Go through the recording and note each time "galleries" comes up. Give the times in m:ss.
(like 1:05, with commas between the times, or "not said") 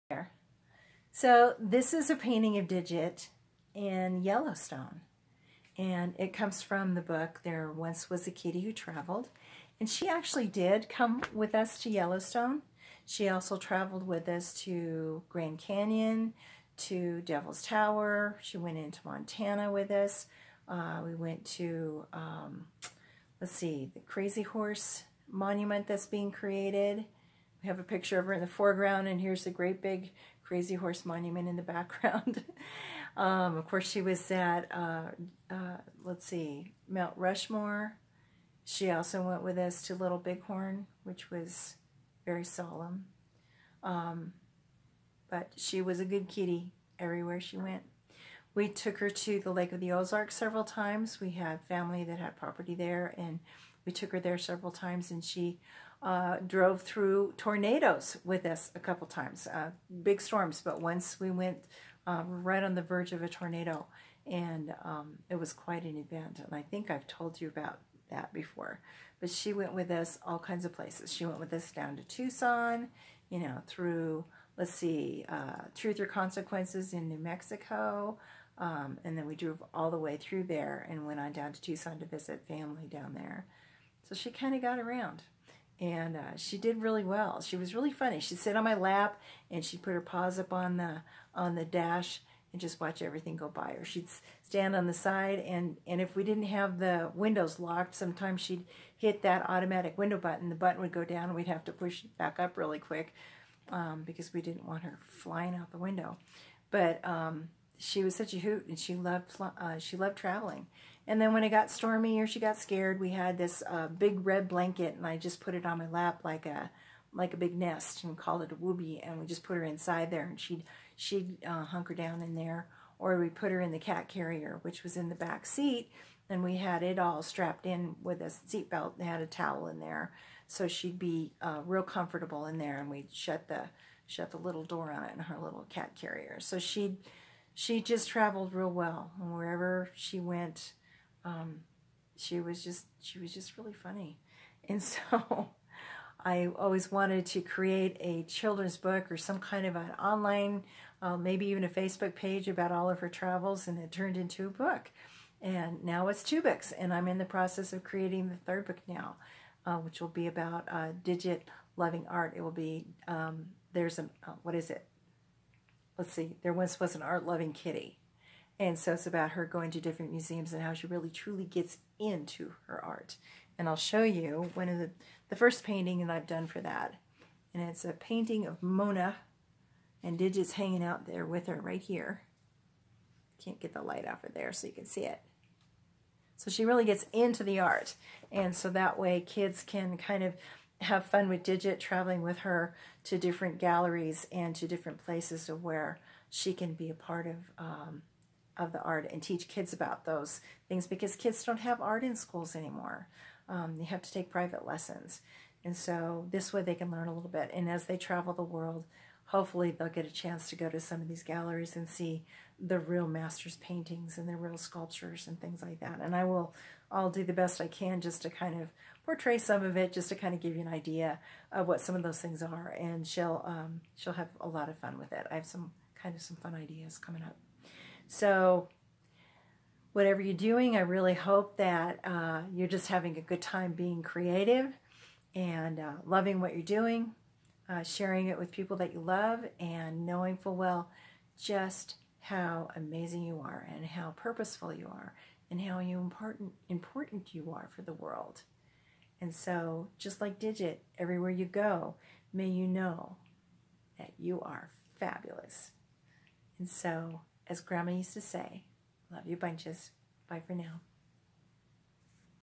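3:13, 3:31.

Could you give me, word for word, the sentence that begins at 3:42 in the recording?
And she'll, um, she'll have a lot of fun with it.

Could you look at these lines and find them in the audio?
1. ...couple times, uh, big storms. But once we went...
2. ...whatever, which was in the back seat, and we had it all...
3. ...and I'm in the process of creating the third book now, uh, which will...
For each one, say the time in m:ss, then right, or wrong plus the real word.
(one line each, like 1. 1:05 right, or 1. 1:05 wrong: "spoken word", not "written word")
1. 0:58 right
2. 2:04 wrong: "carrier", not "whatever"
3. 2:36 right.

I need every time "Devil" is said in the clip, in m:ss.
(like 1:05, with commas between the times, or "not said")
0:17.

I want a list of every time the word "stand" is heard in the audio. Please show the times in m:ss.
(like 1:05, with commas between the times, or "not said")
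1:34.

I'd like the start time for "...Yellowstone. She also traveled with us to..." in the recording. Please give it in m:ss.
0:11.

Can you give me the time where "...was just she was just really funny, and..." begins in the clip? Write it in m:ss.
2:22.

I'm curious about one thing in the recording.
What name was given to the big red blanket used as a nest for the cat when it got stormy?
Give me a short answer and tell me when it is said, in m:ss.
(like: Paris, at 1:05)
whoobie, at 1:58.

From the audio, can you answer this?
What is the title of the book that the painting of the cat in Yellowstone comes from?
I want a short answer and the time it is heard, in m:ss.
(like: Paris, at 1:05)
There Once Was a Kitty Who Traveled, at 0:07.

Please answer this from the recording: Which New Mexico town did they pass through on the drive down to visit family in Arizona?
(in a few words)
Truth or Consequences.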